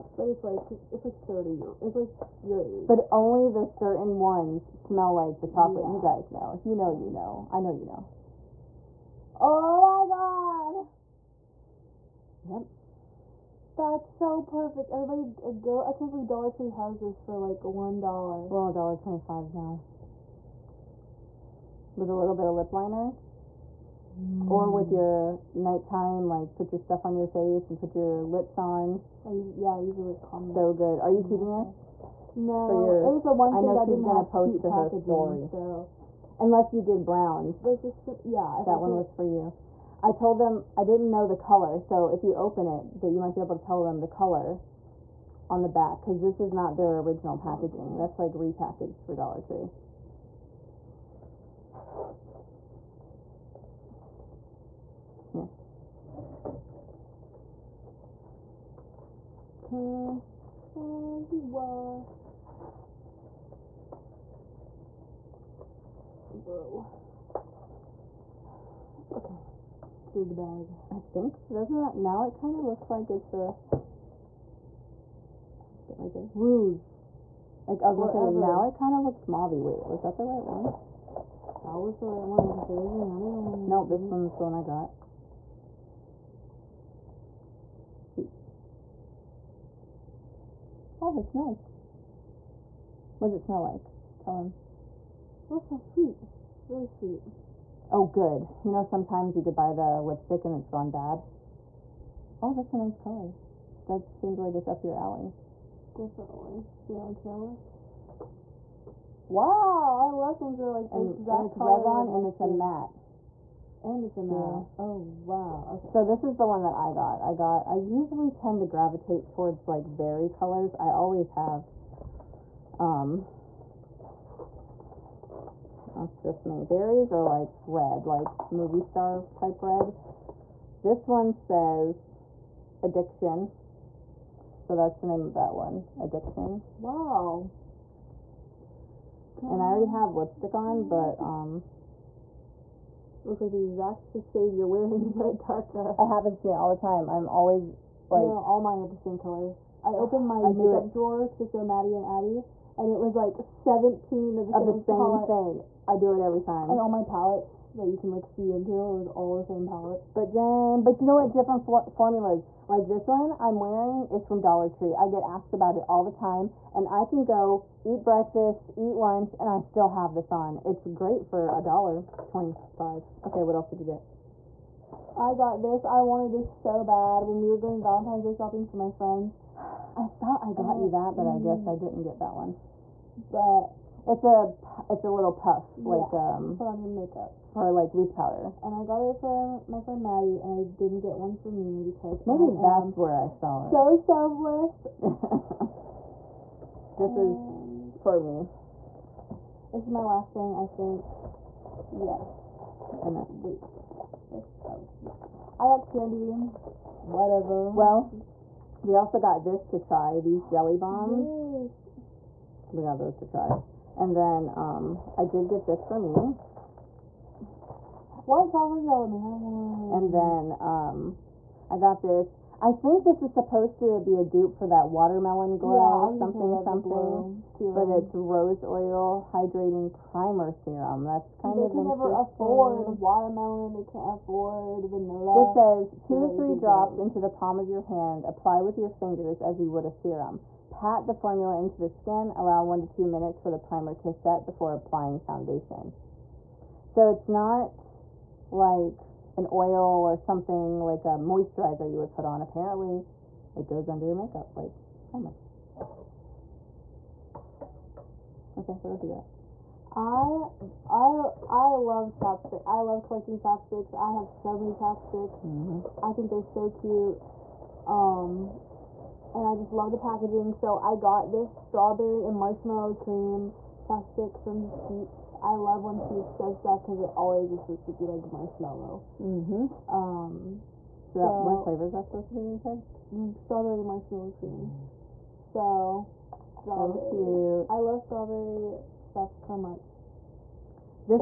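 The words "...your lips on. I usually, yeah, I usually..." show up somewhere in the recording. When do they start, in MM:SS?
00:27.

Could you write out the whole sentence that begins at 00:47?
That's like repackaged for Dollar Tree.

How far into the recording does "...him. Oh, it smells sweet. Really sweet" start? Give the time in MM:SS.
01:34.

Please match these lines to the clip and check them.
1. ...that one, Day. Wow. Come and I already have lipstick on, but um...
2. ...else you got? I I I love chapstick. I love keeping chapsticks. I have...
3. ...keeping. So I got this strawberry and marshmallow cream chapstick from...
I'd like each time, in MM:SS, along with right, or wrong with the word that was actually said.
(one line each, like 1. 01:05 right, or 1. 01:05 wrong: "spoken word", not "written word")
1. 02:15 wrong: "Addiction", not "Day"
2. 04:18 wrong: "collecting", not "keeping"
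3. 04:29 wrong: "packaging", not "keeping".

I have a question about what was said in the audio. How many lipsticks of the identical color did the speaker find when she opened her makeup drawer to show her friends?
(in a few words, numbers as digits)
17.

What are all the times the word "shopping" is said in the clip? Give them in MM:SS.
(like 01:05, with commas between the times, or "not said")
02:58.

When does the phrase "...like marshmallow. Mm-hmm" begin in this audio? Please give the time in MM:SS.
04:38.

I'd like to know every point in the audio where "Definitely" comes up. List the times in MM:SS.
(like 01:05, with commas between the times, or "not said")
01:45.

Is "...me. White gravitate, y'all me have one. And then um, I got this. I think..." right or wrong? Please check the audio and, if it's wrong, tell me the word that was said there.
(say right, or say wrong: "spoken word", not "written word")
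wrong: "chocolate", not "gravitate".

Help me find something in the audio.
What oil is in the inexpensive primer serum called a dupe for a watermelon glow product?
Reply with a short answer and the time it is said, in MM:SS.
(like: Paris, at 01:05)
Rose oil, at 03:48.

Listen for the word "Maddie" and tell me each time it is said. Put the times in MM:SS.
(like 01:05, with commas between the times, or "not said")
02:31, 03:10.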